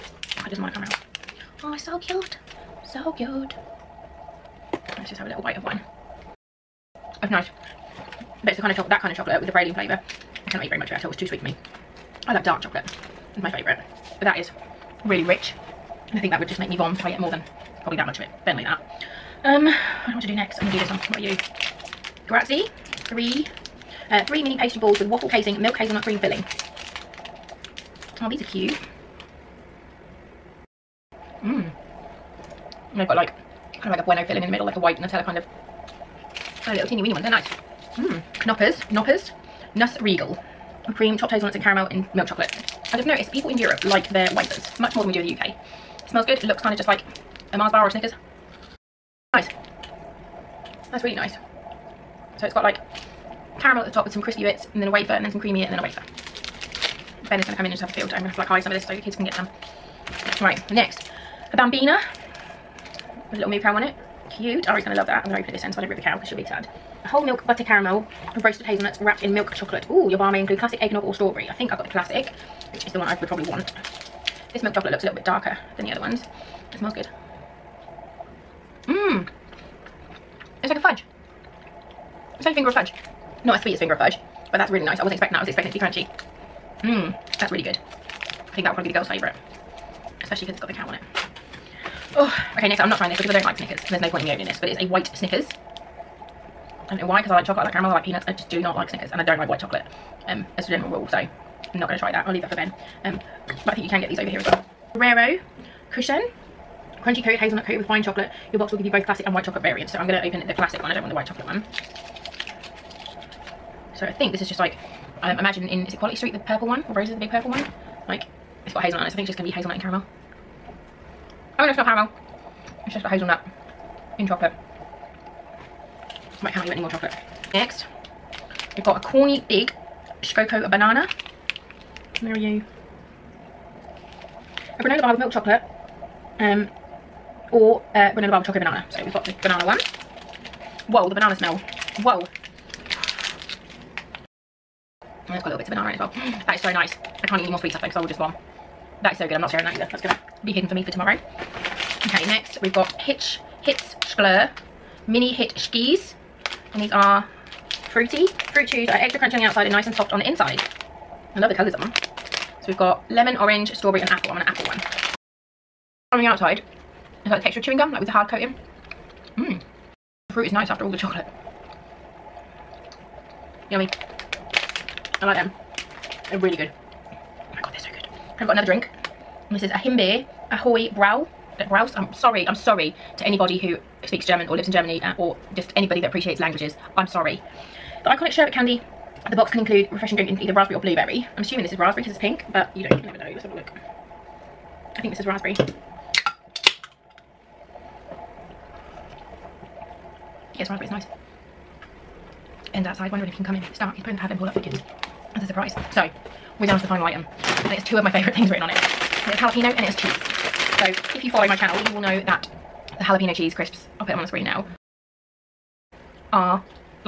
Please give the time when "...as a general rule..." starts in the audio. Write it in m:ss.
1:40.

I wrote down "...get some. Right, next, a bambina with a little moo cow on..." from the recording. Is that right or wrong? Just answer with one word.
right.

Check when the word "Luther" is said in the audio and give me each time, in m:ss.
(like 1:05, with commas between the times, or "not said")
not said.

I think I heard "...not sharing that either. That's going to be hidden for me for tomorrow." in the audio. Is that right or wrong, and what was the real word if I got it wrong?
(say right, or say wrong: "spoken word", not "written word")
right.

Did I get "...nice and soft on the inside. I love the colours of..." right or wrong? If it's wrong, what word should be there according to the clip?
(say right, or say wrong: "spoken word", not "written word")
right.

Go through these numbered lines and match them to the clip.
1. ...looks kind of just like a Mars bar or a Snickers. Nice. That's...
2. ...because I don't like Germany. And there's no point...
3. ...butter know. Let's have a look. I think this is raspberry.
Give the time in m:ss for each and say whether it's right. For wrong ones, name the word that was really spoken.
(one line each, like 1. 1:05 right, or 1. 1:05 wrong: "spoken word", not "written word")
1. 0:46 right
2. 1:33 wrong: "Snickers", not "Germany"
3. 3:13 wrong: "never", not "butter".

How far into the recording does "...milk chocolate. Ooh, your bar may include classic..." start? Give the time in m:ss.
1:09.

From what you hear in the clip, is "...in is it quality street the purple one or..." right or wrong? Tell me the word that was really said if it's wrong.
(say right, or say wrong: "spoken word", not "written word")
right.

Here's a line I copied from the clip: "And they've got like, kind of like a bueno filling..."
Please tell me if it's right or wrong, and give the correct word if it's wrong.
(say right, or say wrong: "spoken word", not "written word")
right.